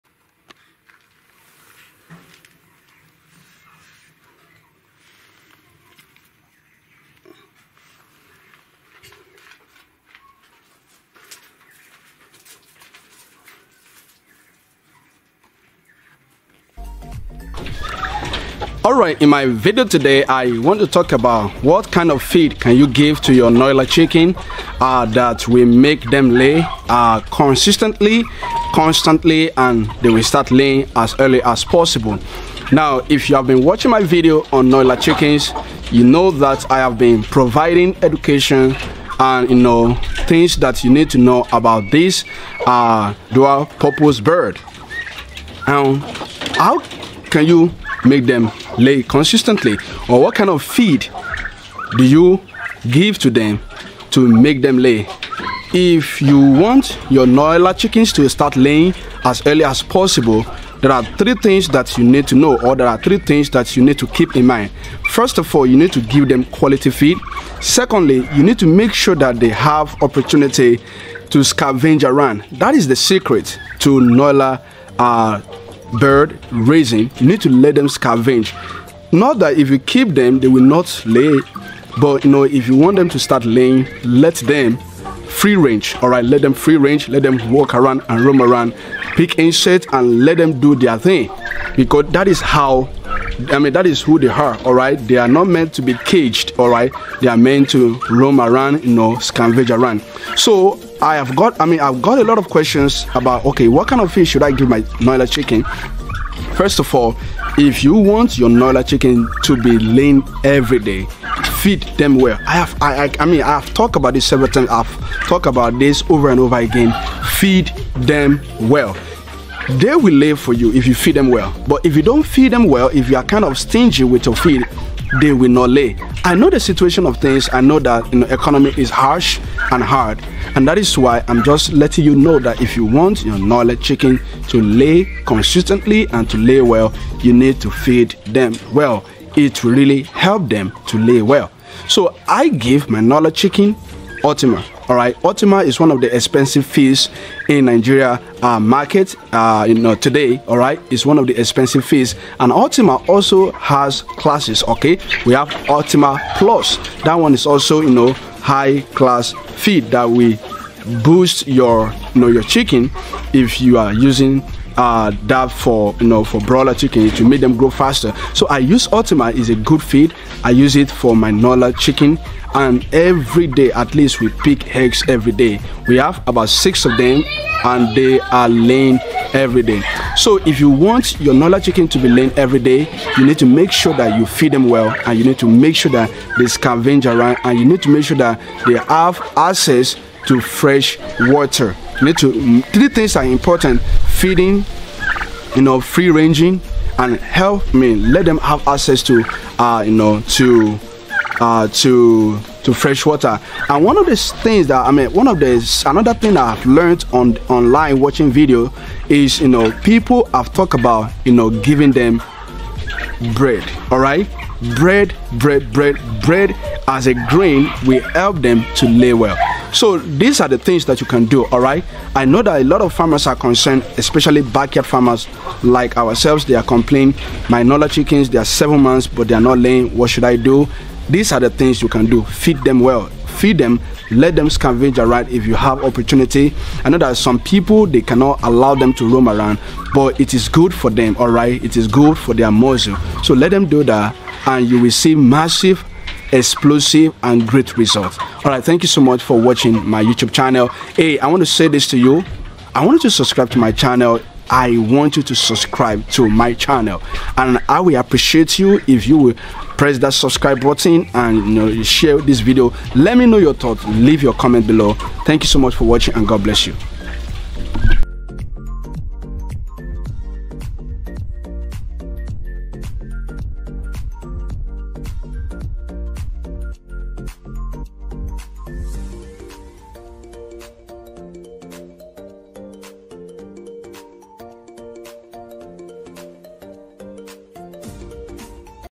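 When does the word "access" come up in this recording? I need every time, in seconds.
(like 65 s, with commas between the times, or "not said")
189 s, 198 s.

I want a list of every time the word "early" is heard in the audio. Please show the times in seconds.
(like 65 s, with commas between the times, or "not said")
31 s, 59 s.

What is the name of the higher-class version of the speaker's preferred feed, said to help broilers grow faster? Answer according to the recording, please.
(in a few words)
Ultima Plus.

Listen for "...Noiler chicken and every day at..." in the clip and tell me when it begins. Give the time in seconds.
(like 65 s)
171 s.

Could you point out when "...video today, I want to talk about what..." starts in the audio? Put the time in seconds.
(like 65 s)
19 s.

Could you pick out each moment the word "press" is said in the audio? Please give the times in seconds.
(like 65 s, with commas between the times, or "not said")
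259 s.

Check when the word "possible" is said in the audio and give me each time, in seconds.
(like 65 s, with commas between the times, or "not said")
31 s, 59 s.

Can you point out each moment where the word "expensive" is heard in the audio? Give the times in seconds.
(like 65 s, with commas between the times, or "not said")
146 s, 151 s.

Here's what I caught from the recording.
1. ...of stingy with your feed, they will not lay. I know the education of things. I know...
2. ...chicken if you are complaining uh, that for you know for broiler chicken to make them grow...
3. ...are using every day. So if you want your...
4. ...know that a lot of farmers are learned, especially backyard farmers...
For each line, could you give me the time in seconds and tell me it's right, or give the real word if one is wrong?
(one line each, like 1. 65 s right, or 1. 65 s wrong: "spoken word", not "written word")
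1. 123 s wrong: "situation", not "education"
2. 162 s wrong: "using", not "complaining"
3. 178 s wrong: "laying", not "using"
4. 222 s wrong: "concerned", not "learned".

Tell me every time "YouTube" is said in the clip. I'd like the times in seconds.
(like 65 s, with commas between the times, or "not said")
250 s.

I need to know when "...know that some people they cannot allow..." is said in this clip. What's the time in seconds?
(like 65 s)
236 s.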